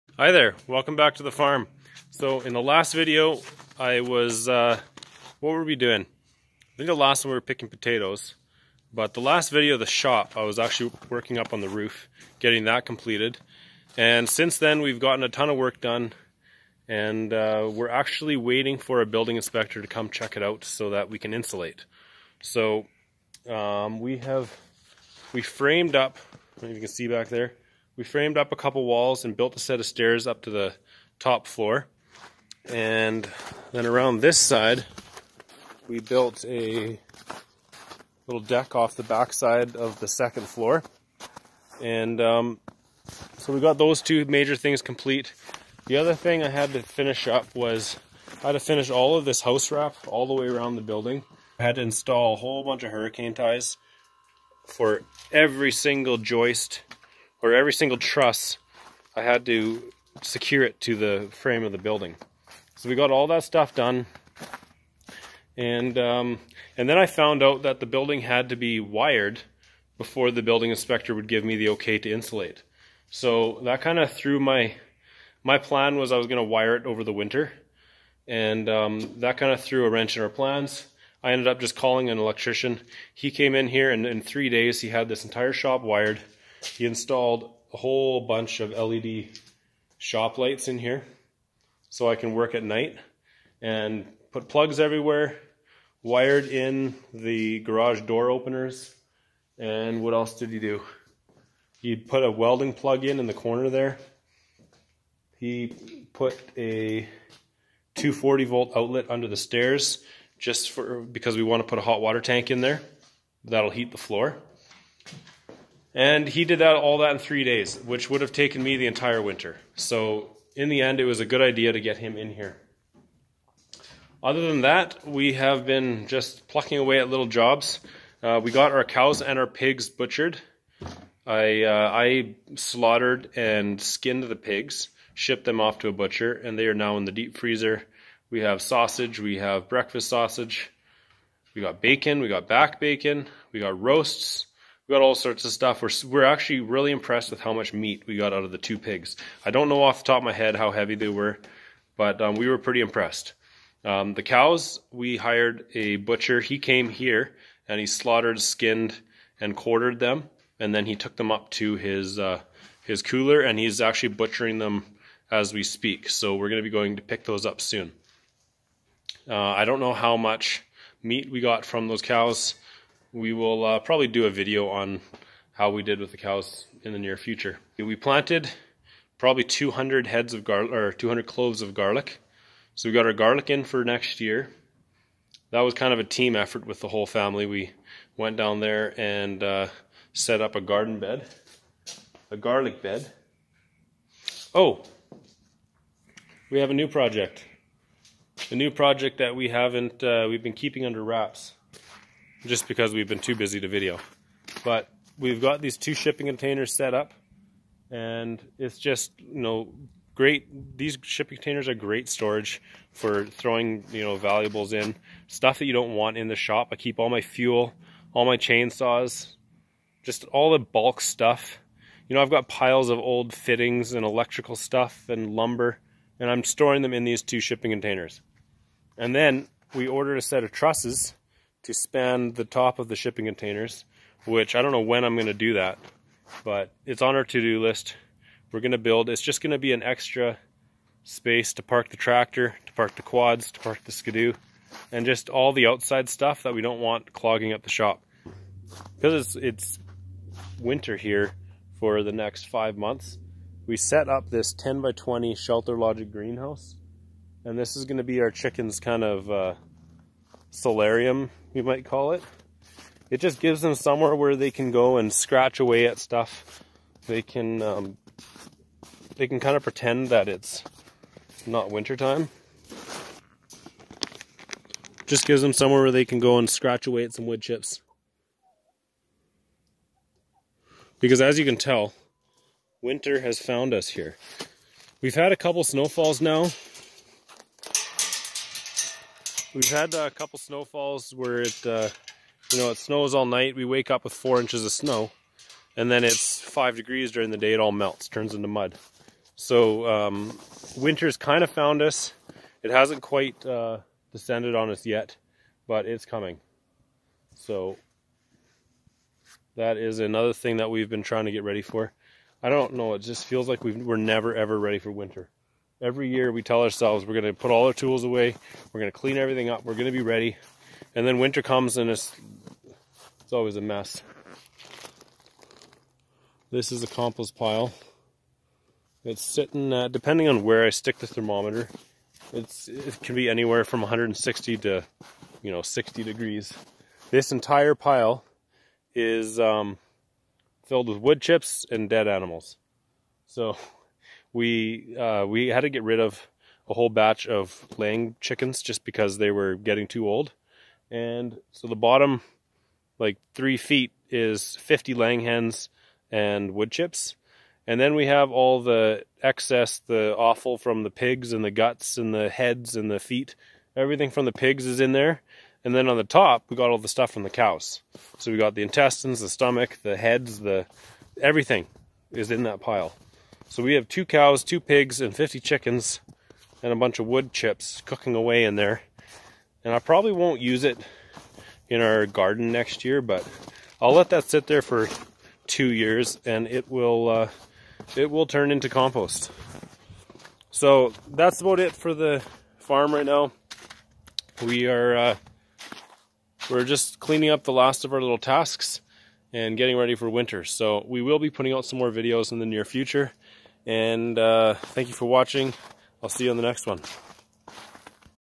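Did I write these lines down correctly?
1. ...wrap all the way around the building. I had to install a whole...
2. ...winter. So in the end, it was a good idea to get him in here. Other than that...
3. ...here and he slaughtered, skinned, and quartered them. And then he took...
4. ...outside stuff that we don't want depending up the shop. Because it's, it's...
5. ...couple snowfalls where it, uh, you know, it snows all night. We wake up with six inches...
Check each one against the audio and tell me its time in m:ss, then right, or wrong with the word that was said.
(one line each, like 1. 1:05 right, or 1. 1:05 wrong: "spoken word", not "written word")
1. 0:49 right
2. 1:59 right
3. 2:36 right
4. 4:05 wrong: "clogging", not "depending"
5. 4:50 wrong: "four", not "six".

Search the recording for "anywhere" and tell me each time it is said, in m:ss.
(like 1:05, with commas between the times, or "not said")
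5:33.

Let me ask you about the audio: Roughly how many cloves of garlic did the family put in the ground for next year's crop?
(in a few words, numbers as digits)
200.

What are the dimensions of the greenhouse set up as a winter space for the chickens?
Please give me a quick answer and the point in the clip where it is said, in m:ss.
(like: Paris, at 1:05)
10 by 20, at 4:14.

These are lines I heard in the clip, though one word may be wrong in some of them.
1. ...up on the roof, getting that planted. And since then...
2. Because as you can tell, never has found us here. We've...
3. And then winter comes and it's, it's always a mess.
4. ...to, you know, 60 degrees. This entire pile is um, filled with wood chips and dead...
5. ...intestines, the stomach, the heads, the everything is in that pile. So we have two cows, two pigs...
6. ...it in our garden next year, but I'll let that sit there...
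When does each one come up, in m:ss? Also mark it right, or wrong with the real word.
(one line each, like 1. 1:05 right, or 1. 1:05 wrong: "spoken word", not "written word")
1. 0:11 wrong: "completed", not "planted"
2. 4:41 wrong: "winter", not "never"
3. 5:20 right
4. 5:34 right
5. 6:08 right
6. 6:20 right.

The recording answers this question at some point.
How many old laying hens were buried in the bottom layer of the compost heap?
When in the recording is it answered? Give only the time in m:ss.
5:54.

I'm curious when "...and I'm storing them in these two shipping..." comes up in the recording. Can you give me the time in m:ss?
3:46.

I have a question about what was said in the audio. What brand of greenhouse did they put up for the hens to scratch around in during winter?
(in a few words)
Shelter Logic.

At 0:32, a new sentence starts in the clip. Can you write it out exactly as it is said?
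And then around this side, we built a little deck off the backside of the second floor.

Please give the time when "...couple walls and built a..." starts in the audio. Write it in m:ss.
0:28.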